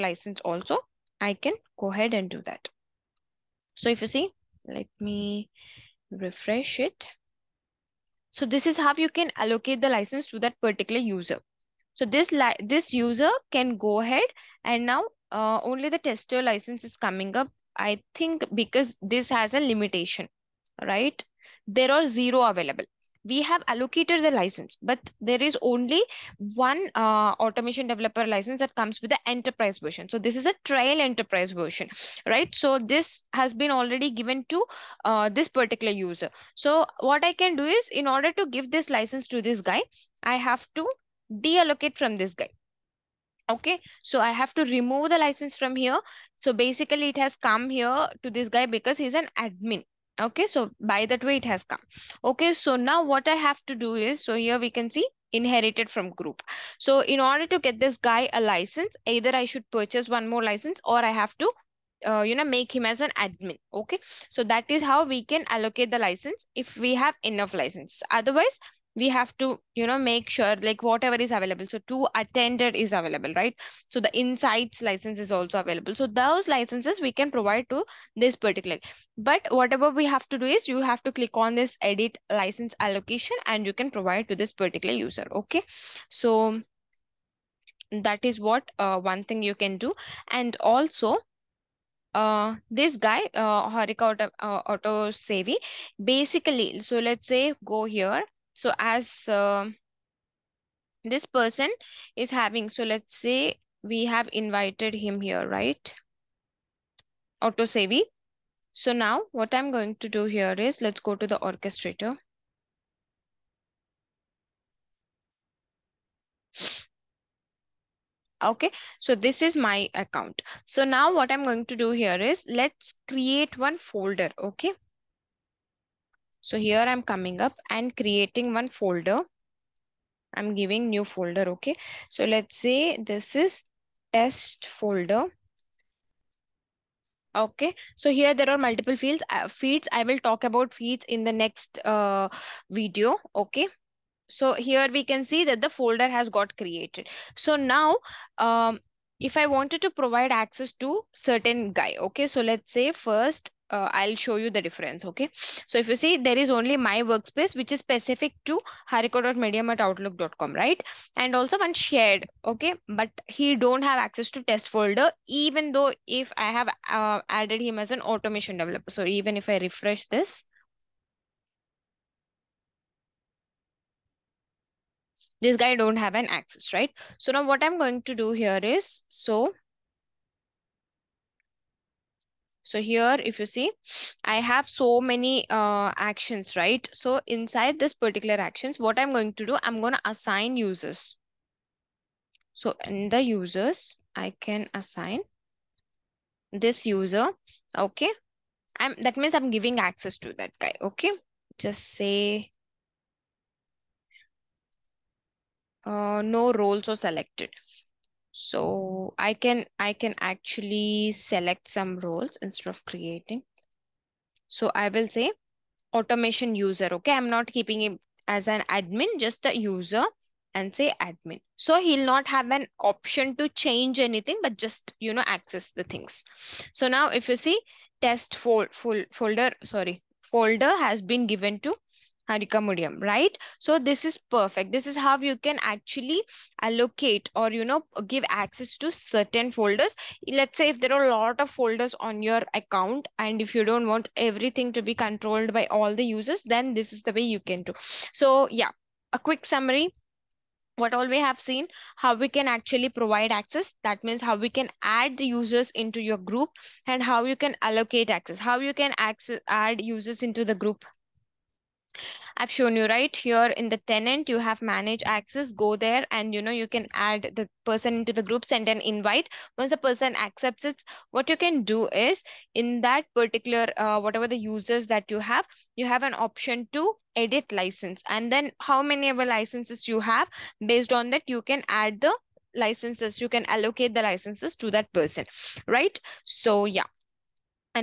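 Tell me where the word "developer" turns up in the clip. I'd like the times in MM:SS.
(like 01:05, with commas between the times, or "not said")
00:27, 02:48.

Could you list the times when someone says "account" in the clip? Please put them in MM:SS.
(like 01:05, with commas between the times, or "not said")
01:59, 04:02.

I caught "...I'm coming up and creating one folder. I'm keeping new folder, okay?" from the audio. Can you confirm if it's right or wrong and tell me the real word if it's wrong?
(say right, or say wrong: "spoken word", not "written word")
wrong: "giving", not "keeping".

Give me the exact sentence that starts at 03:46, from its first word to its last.
So now if you see test fold, full folder, sorry, folder has been given to Harika Mudiam, right?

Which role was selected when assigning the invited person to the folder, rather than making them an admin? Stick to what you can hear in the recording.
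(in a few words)
automation user.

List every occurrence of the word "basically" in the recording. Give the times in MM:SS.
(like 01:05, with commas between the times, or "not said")
00:46, 01:36.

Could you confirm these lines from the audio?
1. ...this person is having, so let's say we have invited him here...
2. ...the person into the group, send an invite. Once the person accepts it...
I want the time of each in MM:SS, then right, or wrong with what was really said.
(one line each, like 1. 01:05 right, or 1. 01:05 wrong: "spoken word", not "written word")
1. 01:41 right
2. 04:27 right.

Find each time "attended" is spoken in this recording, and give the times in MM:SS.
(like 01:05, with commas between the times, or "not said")
01:12.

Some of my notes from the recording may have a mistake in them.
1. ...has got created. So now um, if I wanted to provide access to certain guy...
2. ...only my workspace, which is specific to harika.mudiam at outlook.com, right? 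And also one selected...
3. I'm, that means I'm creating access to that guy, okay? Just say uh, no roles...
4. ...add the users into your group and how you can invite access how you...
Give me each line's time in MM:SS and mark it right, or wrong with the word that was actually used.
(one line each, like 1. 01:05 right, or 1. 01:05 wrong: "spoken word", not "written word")
1. 02:26 right
2. 02:36 wrong: "shared", not "selected"
3. 03:18 wrong: "giving", not "creating"
4. 04:14 wrong: "allocate", not "invite".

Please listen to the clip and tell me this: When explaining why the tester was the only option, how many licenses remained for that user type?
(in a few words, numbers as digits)
0.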